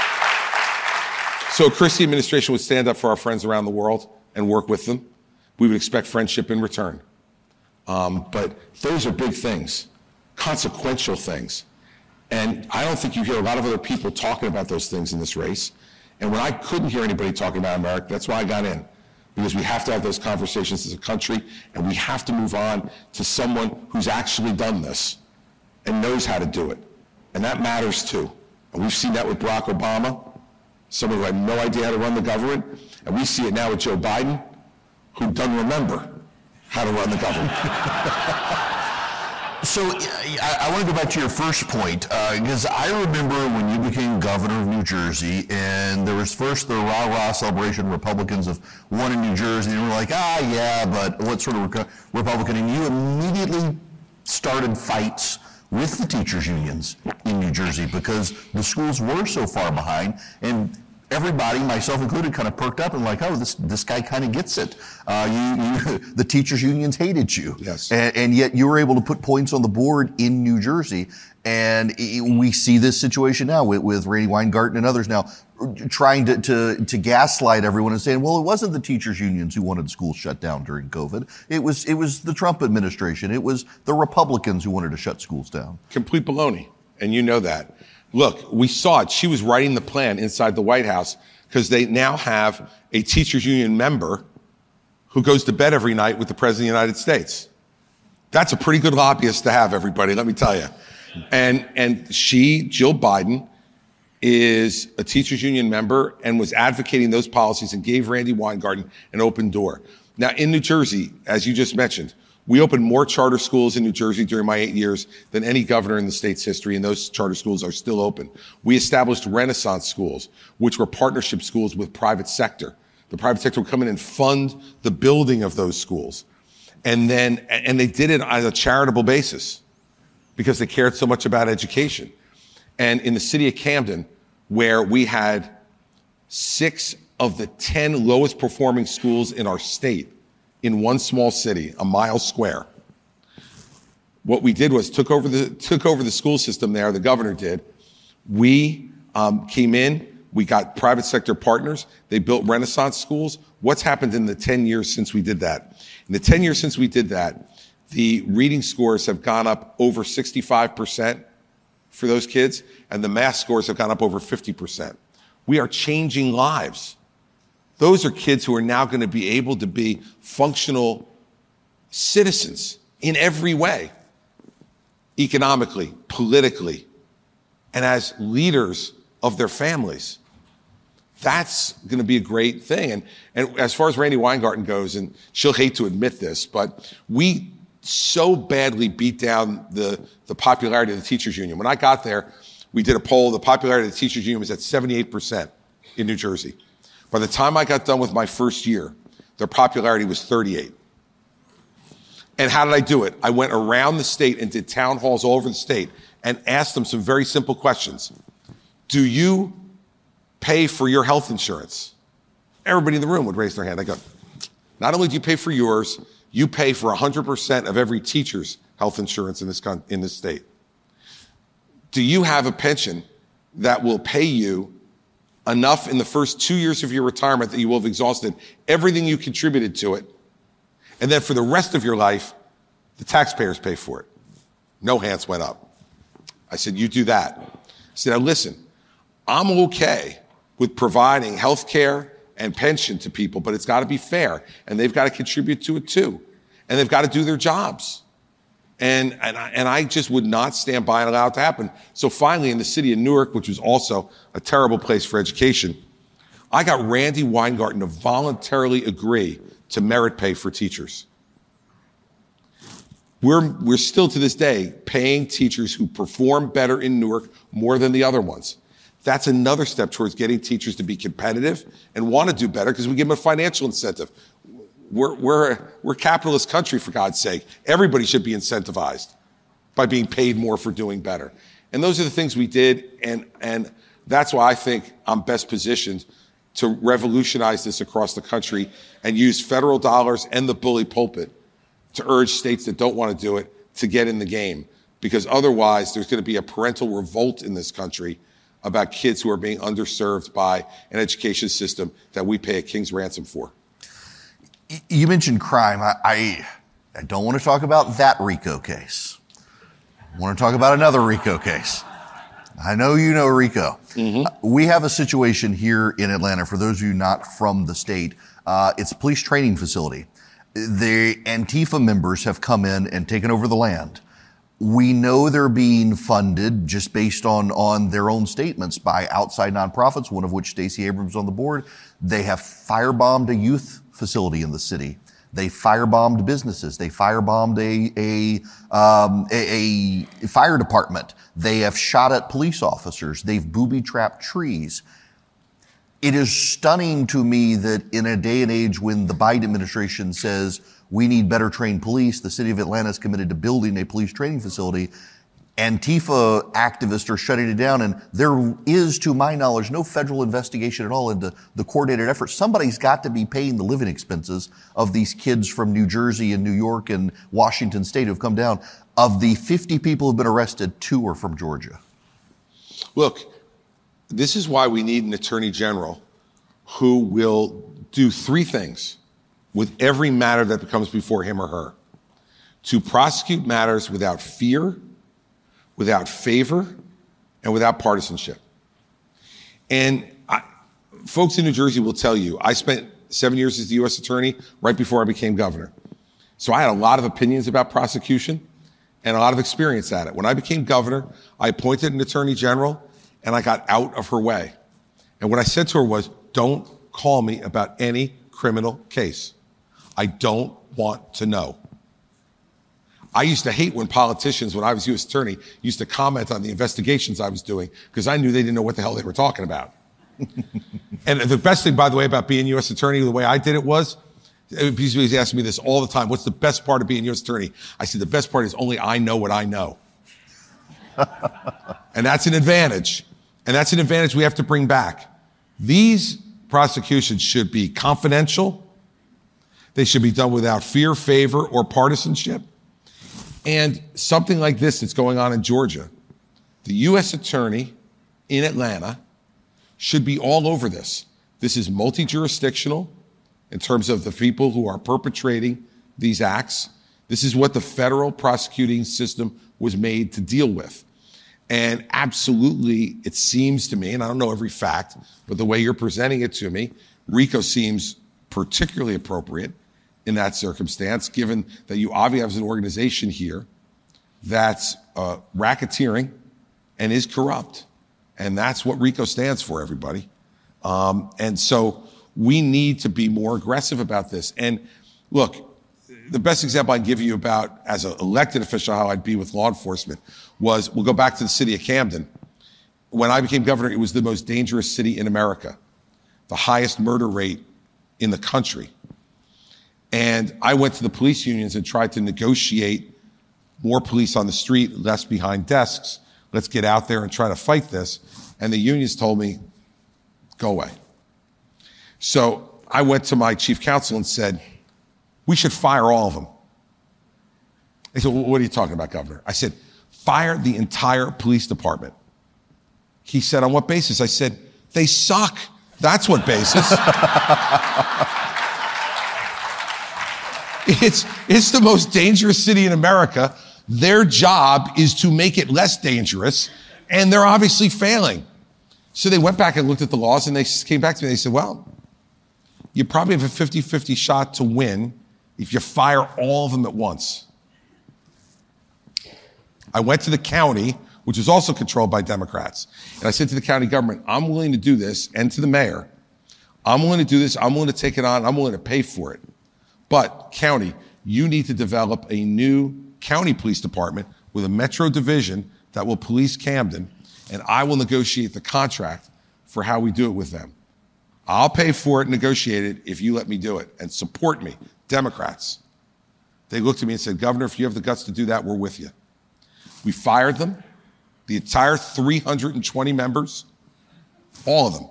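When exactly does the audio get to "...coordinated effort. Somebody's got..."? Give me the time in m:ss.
6:01.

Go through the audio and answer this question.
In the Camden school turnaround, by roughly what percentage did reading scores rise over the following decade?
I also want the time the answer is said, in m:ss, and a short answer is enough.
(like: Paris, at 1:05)
65%, at 2:40.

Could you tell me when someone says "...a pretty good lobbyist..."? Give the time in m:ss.
1:38.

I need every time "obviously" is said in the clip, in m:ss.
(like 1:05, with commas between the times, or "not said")
7:51, 8:57.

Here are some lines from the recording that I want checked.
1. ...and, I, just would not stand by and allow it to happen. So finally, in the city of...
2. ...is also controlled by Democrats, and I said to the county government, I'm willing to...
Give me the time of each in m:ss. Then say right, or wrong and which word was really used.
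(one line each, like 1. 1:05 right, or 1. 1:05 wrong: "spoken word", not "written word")
1. 4:09 right
2. 9:11 right.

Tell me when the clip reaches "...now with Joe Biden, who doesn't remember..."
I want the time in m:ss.
0:33.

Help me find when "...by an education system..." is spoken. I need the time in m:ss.
5:00.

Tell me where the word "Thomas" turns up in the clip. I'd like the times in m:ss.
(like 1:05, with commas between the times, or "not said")
not said.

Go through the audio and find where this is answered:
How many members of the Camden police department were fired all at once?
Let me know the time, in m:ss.
9:41.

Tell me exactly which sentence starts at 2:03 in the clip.
The private sector would come in and fund the building of those schools.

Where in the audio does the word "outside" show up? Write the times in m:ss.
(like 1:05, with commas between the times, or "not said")
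5:29.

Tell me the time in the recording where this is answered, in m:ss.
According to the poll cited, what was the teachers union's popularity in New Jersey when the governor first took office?
3:14.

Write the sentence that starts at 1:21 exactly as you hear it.
It was it was the Trump administration.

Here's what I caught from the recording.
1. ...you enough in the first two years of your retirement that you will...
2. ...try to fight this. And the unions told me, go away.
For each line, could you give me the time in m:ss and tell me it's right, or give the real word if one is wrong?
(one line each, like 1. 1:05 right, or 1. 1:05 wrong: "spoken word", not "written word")
1. 3:44 right
2. 8:27 right.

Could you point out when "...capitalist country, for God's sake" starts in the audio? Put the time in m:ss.
4:35.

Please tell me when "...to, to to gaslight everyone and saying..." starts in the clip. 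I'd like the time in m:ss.
1:16.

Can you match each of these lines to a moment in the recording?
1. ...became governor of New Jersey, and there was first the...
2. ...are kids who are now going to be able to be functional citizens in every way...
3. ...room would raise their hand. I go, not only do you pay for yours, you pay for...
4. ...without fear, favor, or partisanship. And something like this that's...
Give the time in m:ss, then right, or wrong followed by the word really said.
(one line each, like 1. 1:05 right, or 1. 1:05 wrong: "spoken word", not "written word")
1. 0:43 right
2. 2:48 right
3. 3:33 right
4. 7:20 right.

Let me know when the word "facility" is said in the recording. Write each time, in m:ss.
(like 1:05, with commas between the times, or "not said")
5:19, 5:34, 5:54.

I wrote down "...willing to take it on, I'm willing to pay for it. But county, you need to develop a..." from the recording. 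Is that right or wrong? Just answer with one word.
right.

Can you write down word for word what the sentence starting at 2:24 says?
What we did was took over the, took over the school system there, the governor did.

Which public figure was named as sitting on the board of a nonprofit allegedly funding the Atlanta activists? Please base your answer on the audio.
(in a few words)
Stacey Abrams.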